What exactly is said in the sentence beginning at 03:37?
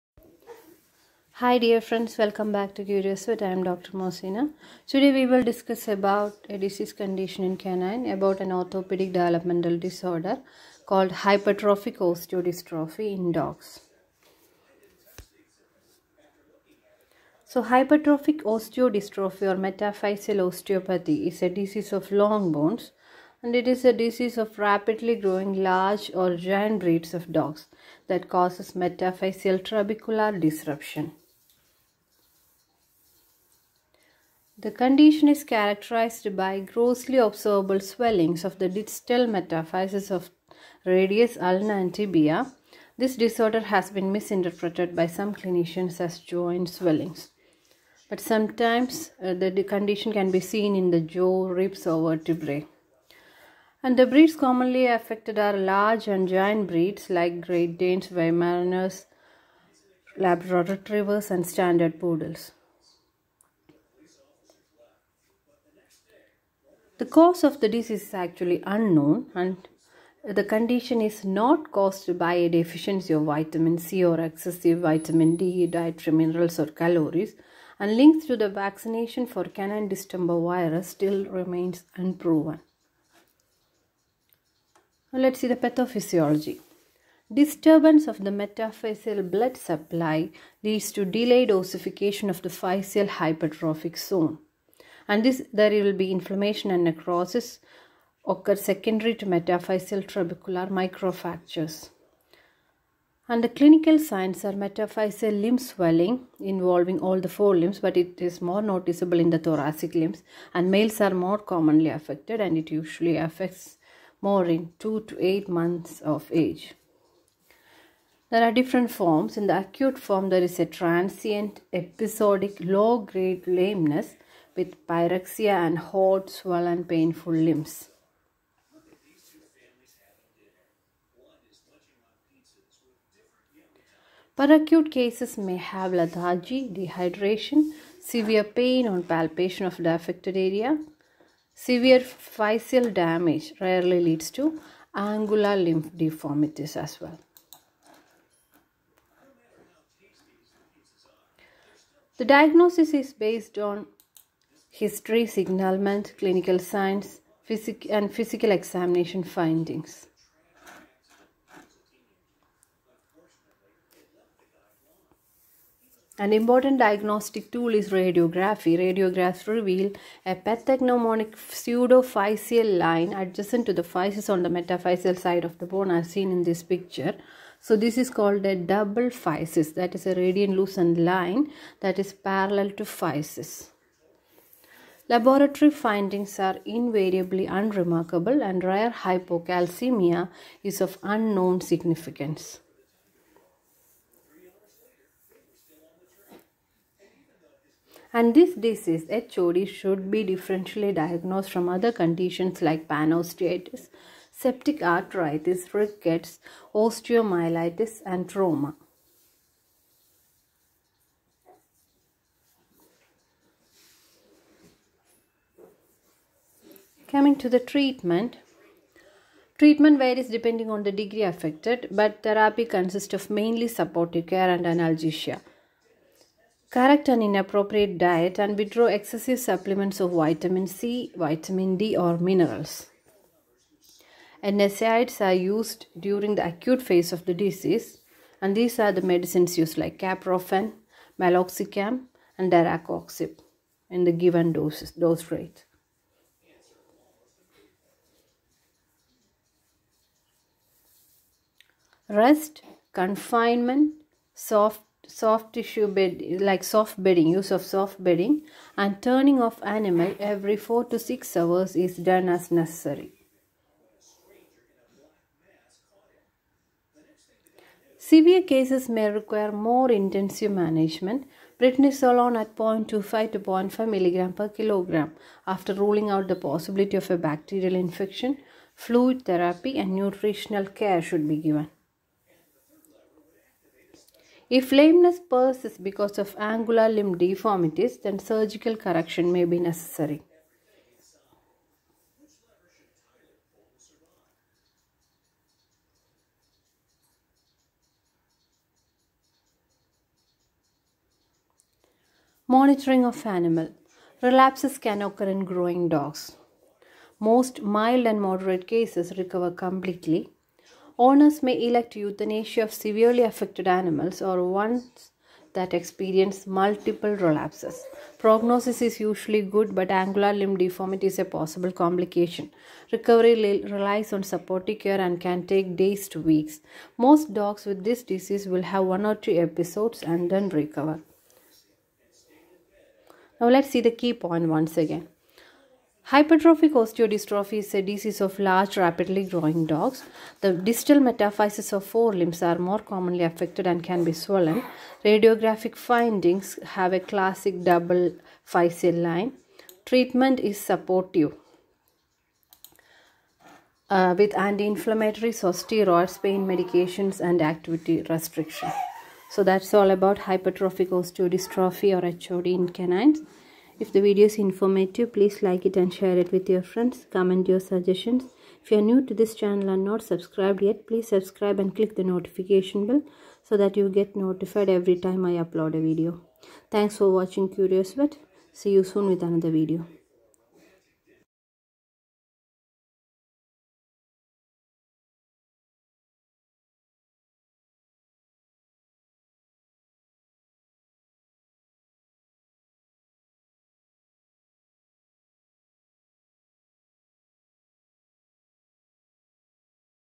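Coming to the treatment, treatment varies depending on the degree affected, but therapy consists of mainly supportive care and analgesia.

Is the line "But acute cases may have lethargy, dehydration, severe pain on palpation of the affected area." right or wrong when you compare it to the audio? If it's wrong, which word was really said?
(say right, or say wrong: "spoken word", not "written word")
right.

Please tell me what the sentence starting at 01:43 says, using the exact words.
And the clinical signs are metaphyseal limb swelling involving all the four limbs, but it is more noticeable in the thoracic limbs.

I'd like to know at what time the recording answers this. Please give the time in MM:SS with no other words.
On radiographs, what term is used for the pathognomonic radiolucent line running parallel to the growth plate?
02:51.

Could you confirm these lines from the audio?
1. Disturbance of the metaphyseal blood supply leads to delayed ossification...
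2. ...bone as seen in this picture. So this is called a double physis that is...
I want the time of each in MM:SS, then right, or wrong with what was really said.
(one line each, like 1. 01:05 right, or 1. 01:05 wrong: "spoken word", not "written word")
1. 01:27 right
2. 02:55 right.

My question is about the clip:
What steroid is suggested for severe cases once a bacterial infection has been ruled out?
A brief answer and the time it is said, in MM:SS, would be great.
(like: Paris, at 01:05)
Prednisolone, at 04:31.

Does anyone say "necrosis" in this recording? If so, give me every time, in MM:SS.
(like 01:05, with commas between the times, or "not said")
01:36.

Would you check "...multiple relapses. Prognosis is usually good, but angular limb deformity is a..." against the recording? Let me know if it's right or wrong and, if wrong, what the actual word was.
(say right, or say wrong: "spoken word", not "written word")
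right.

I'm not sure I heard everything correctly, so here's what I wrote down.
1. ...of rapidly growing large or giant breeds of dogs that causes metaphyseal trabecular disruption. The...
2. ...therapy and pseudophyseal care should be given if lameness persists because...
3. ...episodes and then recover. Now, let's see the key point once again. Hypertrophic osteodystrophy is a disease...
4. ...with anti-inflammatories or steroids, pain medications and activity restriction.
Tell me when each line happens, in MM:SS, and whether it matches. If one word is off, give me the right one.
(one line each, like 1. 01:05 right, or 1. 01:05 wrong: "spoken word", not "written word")
1. 00:24 right
2. 04:39 wrong: "nutritional", not "pseudophyseal"
3. 05:29 right
4. 05:54 right.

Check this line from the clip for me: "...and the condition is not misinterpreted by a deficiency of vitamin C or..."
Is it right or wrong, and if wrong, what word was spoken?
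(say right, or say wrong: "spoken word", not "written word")
wrong: "caused", not "misinterpreted".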